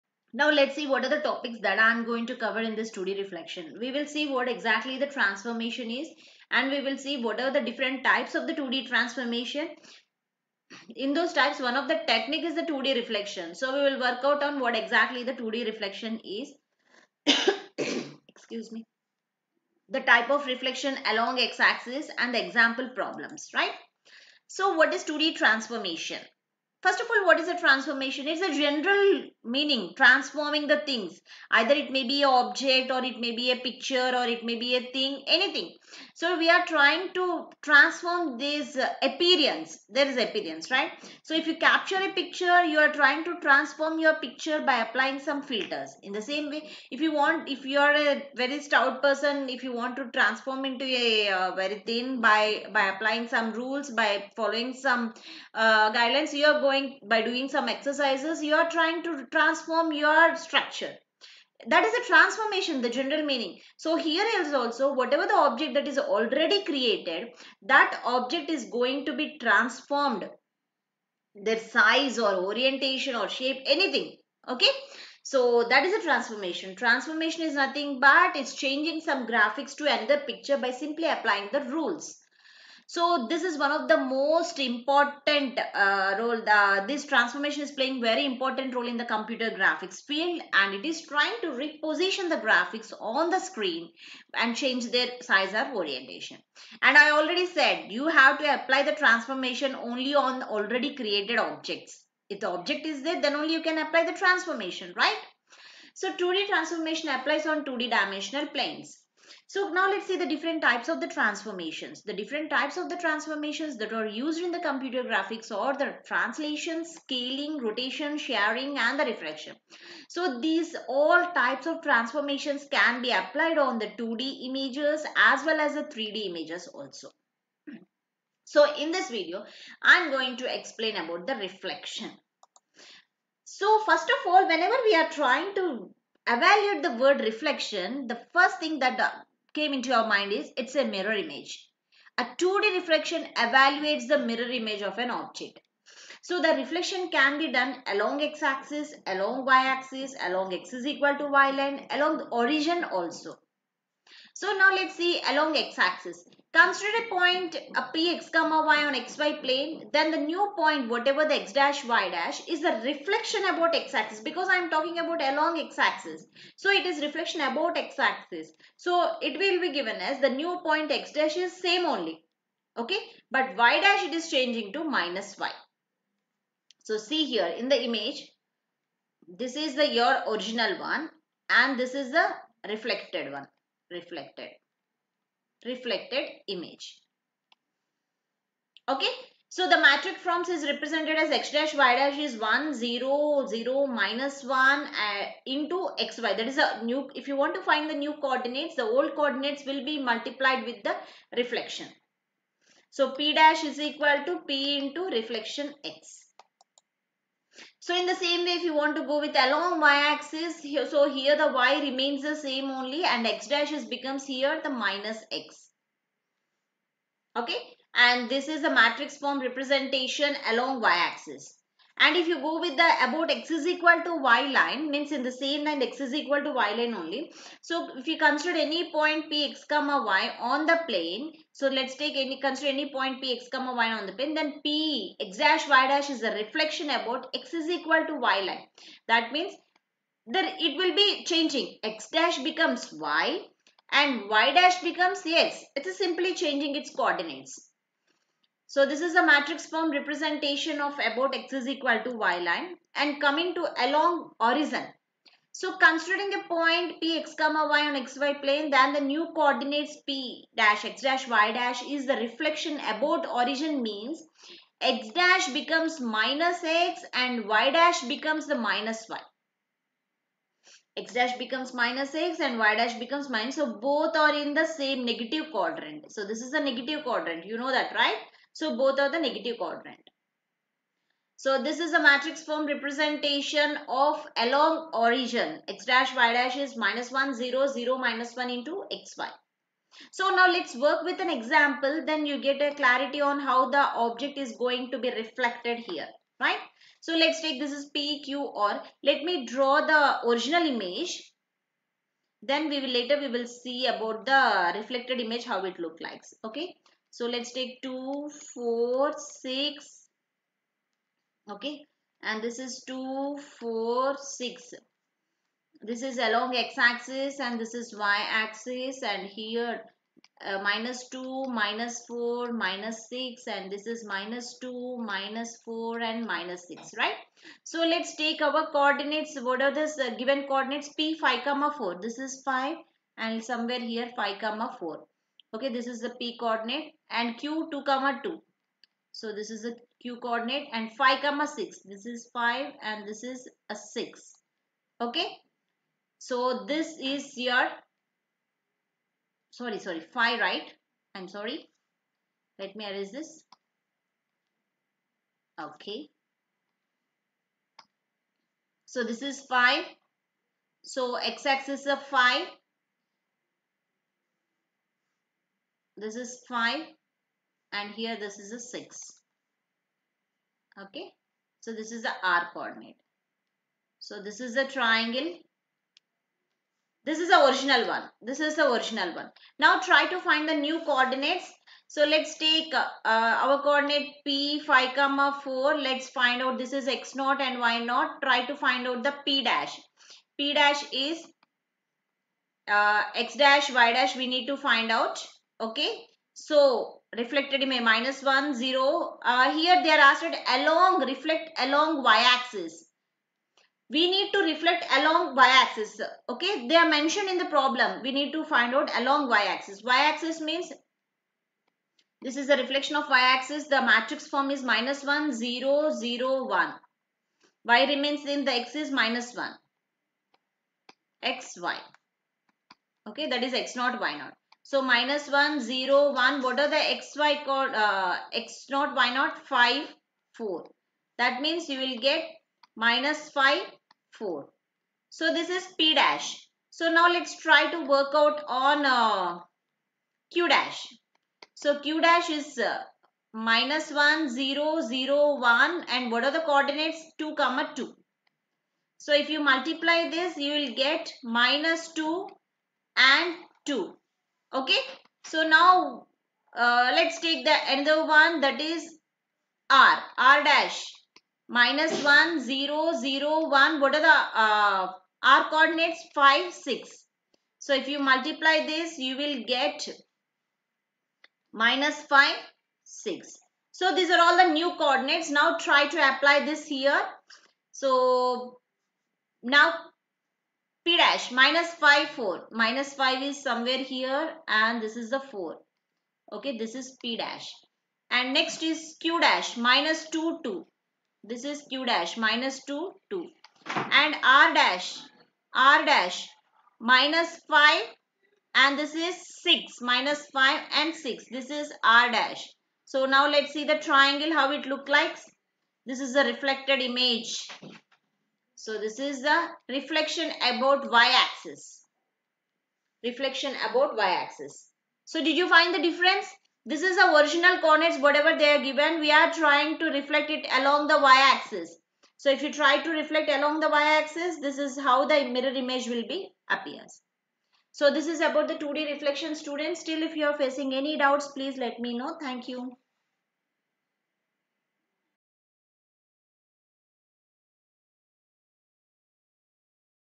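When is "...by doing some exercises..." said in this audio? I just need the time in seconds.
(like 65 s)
57 s.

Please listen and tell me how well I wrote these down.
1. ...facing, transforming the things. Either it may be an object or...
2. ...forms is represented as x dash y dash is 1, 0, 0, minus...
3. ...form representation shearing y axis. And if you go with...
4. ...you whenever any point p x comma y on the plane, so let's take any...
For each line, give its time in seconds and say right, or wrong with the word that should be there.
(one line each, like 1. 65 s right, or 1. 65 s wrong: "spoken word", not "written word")
1. 29 s wrong: "meaning", not "facing"
2. 190 s right
3. 219 s wrong: "along", not "shearing"
4. 228 s wrong: "consider", not "whenever".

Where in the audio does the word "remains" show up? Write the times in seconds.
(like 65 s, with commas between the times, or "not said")
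211 s, 417 s.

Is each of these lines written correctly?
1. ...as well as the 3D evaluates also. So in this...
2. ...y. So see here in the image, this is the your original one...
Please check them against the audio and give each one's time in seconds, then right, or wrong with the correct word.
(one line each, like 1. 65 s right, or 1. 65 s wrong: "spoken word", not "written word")
1. 125 s wrong: "images", not "evaluates"
2. 175 s right.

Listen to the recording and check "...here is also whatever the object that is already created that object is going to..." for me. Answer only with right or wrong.
right.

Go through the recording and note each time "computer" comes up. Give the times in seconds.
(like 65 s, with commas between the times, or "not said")
89 s, 114 s.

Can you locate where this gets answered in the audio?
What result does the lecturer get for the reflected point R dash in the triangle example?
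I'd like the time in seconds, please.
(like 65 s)
471 s.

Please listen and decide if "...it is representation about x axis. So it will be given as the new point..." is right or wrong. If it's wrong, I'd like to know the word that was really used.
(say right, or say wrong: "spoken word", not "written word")
wrong: "reflection", not "representation".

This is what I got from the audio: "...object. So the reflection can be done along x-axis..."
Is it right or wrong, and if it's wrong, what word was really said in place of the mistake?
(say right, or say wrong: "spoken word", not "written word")
right.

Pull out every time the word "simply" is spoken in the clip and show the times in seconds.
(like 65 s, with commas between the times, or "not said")
80 s, 245 s.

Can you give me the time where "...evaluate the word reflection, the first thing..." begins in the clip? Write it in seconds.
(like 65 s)
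136 s.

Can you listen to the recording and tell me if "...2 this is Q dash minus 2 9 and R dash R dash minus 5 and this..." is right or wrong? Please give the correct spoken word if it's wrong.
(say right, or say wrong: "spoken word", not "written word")
wrong: "2", not "9".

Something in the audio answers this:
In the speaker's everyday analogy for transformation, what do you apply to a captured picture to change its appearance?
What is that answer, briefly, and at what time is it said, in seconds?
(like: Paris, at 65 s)
filters, at 45 s.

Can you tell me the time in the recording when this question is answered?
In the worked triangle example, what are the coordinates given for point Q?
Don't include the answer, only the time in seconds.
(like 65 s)
337 s.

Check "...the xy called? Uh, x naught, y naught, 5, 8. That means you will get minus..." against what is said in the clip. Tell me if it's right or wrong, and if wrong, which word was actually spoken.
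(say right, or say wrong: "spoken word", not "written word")
wrong: "4", not "8".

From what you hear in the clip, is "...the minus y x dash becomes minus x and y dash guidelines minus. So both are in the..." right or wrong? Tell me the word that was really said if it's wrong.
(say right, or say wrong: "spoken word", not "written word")
wrong: "becomes", not "guidelines".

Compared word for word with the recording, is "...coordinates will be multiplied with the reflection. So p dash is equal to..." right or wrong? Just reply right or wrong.
right.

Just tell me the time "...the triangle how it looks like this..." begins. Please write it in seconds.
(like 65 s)
503 s.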